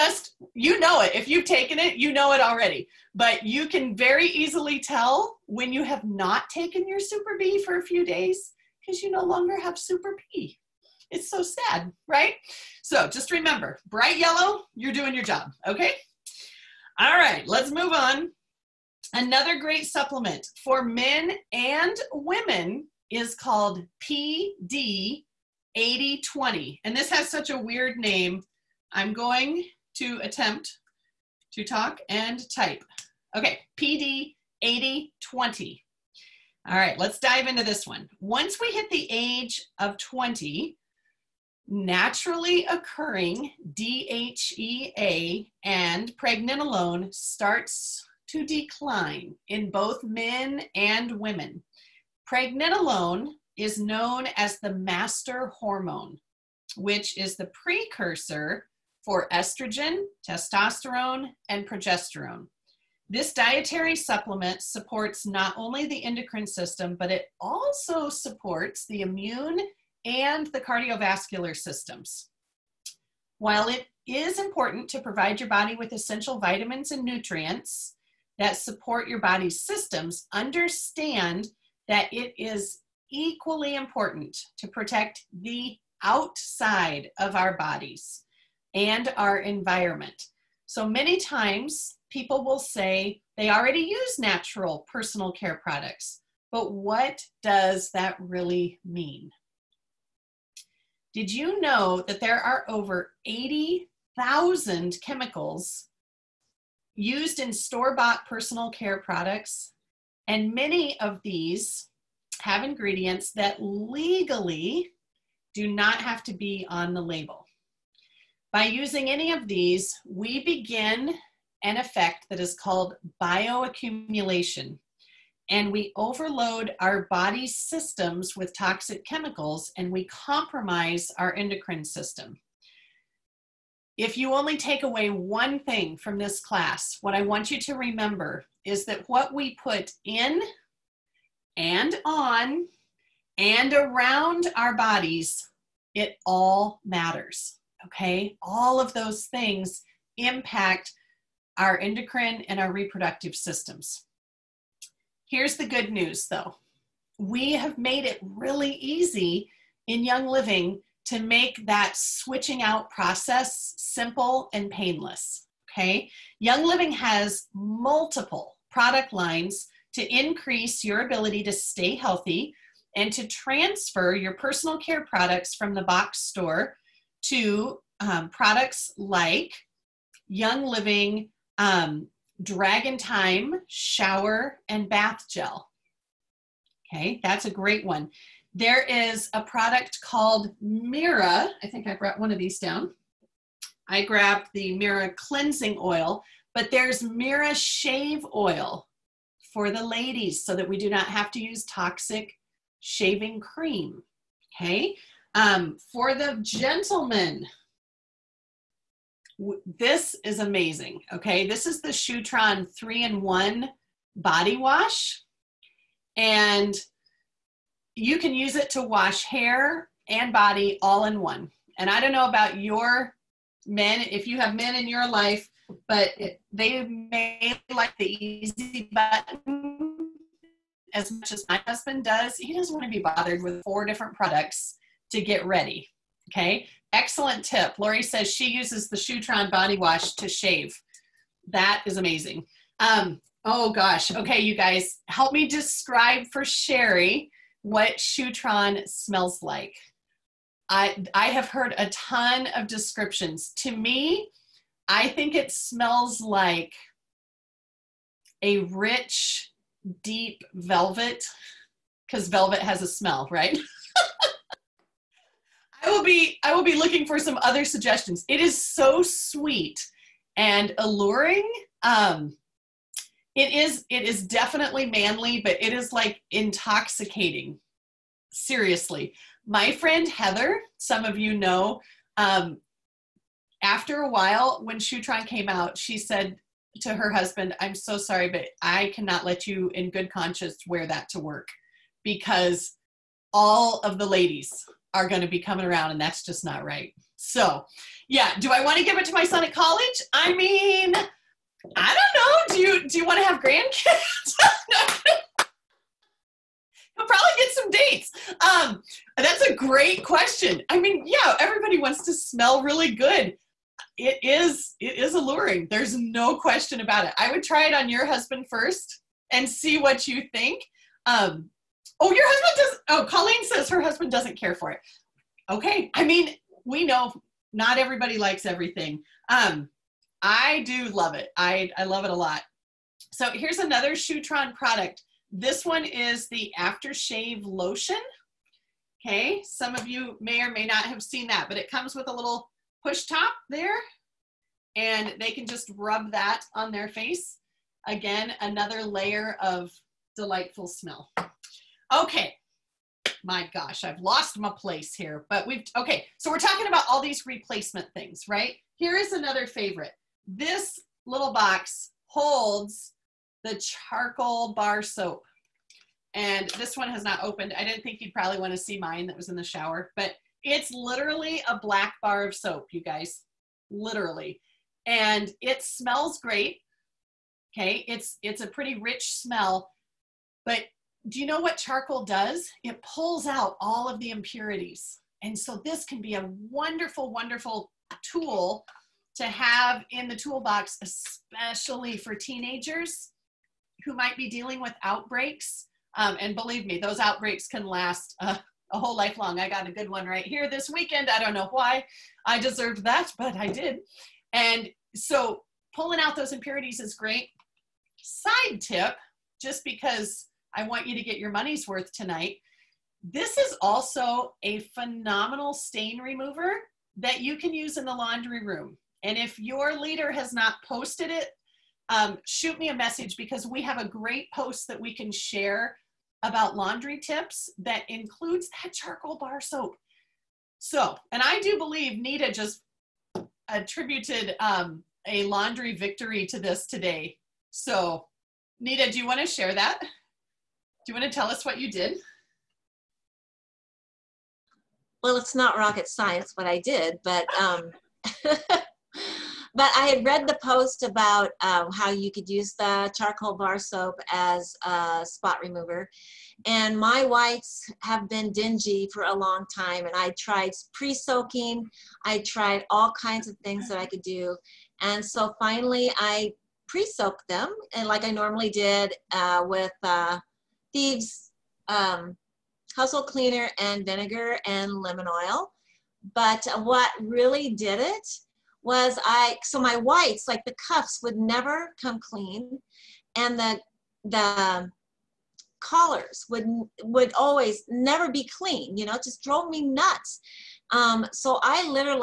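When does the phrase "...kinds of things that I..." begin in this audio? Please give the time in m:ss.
7:42.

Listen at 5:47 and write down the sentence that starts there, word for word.
Again, another layer of delightful smell.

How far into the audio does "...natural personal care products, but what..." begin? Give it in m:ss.
1:34.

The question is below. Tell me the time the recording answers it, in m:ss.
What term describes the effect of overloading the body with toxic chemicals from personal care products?
2:03.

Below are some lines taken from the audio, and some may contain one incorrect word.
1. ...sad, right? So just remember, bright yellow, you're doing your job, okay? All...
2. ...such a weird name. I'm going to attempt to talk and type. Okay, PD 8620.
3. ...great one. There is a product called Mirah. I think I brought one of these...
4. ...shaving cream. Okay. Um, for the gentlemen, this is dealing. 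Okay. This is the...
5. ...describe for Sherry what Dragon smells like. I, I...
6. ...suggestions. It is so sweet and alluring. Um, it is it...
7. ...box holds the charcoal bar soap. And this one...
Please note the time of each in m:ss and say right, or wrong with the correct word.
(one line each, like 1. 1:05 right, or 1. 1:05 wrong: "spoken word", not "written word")
1. 0:11 right
2. 0:27 wrong: "8020", not "8620"
3. 3:07 right
4. 3:22 wrong: "amazing", not "dealing"
5. 4:05 wrong: "Shutran", not "Dragon"
6. 4:27 right
7. 6:01 right.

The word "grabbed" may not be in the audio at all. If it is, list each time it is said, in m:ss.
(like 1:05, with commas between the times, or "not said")
3:14.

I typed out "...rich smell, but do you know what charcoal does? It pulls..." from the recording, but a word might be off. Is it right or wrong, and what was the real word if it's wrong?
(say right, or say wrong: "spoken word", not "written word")
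right.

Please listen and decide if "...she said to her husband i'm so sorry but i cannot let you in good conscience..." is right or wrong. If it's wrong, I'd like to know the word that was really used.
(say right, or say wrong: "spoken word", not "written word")
right.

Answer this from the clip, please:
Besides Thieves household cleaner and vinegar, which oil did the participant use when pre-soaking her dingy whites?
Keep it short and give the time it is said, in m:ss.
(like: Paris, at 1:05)
Lemon oil, at 7:54.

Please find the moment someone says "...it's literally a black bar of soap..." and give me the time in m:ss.
6:10.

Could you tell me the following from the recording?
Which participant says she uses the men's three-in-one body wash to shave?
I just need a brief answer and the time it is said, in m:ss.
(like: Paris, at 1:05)
Lori, at 3:57.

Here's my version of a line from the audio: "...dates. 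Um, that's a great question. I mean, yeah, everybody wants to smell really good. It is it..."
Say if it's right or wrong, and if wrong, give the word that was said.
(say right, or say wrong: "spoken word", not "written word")
right.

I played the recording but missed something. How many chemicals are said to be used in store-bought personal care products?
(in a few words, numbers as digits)
Over 80,000.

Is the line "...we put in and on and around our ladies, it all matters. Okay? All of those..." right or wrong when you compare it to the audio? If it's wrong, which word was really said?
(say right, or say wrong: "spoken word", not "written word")
wrong: "bodies", not "ladies".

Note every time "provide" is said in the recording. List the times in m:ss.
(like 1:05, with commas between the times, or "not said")
1:14.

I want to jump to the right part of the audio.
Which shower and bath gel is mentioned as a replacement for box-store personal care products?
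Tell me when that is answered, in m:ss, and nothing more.
3:02.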